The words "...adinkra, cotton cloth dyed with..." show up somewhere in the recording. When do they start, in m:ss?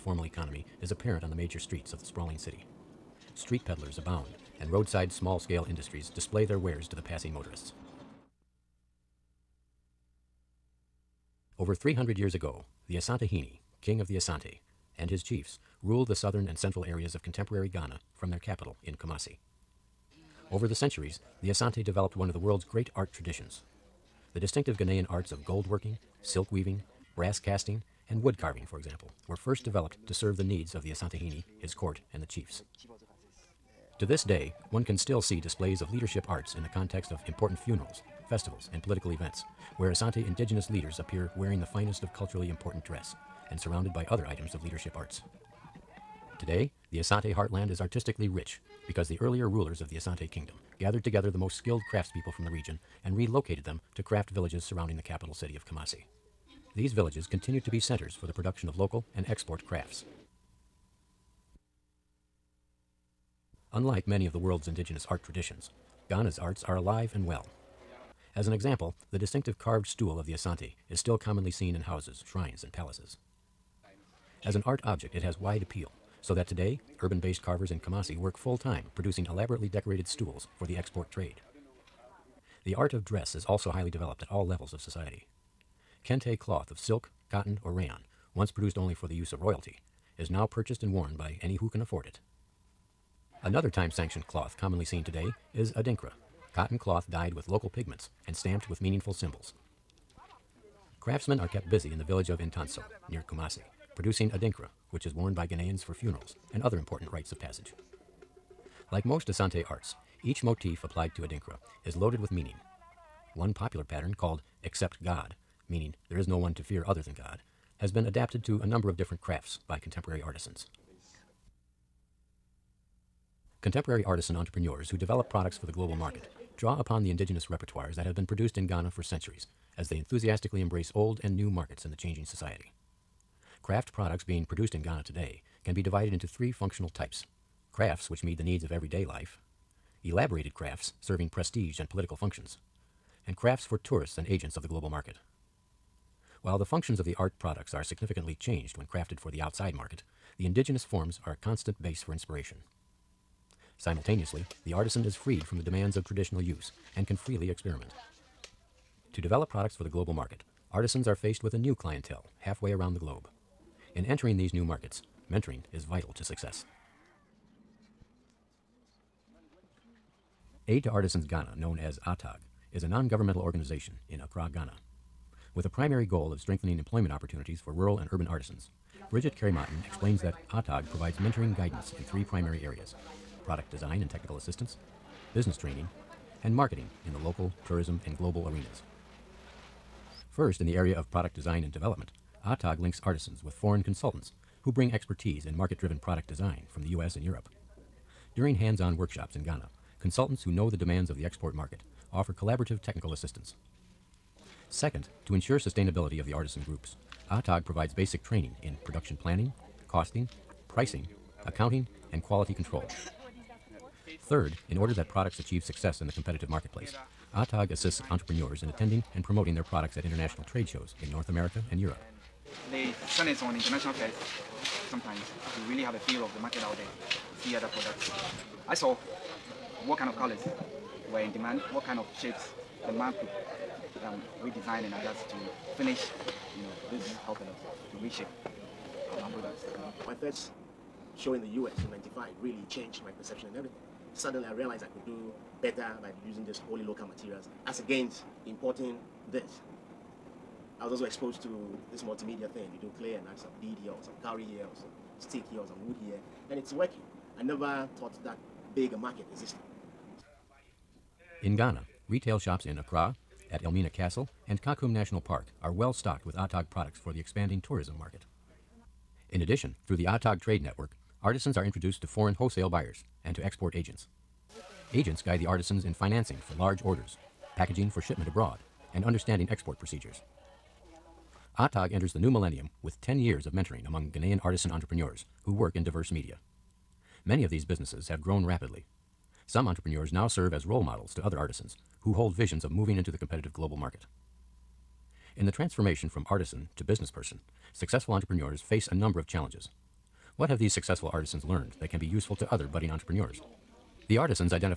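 1:35.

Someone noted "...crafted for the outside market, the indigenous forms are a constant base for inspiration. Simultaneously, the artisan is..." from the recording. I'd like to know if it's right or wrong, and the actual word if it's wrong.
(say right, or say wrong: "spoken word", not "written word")
right.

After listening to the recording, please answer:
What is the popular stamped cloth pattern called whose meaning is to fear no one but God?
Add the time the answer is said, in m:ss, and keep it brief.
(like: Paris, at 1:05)
Except God, at 1:54.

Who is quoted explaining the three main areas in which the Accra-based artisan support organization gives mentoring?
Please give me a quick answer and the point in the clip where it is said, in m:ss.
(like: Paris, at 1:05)
Bridget Carey-Martin, at 2:59.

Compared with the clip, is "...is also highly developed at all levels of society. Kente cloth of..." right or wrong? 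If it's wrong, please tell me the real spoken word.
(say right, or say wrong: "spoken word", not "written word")
right.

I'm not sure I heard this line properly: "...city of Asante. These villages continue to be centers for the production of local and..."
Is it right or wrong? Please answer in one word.
wrong.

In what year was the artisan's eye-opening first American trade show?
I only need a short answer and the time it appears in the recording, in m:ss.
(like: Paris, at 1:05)
1995, at 4:01.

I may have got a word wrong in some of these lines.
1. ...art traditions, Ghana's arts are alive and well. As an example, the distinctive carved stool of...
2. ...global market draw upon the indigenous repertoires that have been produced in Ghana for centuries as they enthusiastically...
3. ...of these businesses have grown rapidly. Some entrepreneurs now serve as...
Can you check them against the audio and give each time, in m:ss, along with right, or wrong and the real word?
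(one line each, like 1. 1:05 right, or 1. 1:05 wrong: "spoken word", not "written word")
1. 1:05 right
2. 2:05 right
3. 4:47 right.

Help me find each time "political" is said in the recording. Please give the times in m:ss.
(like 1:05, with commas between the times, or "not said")
0:38, 2:21.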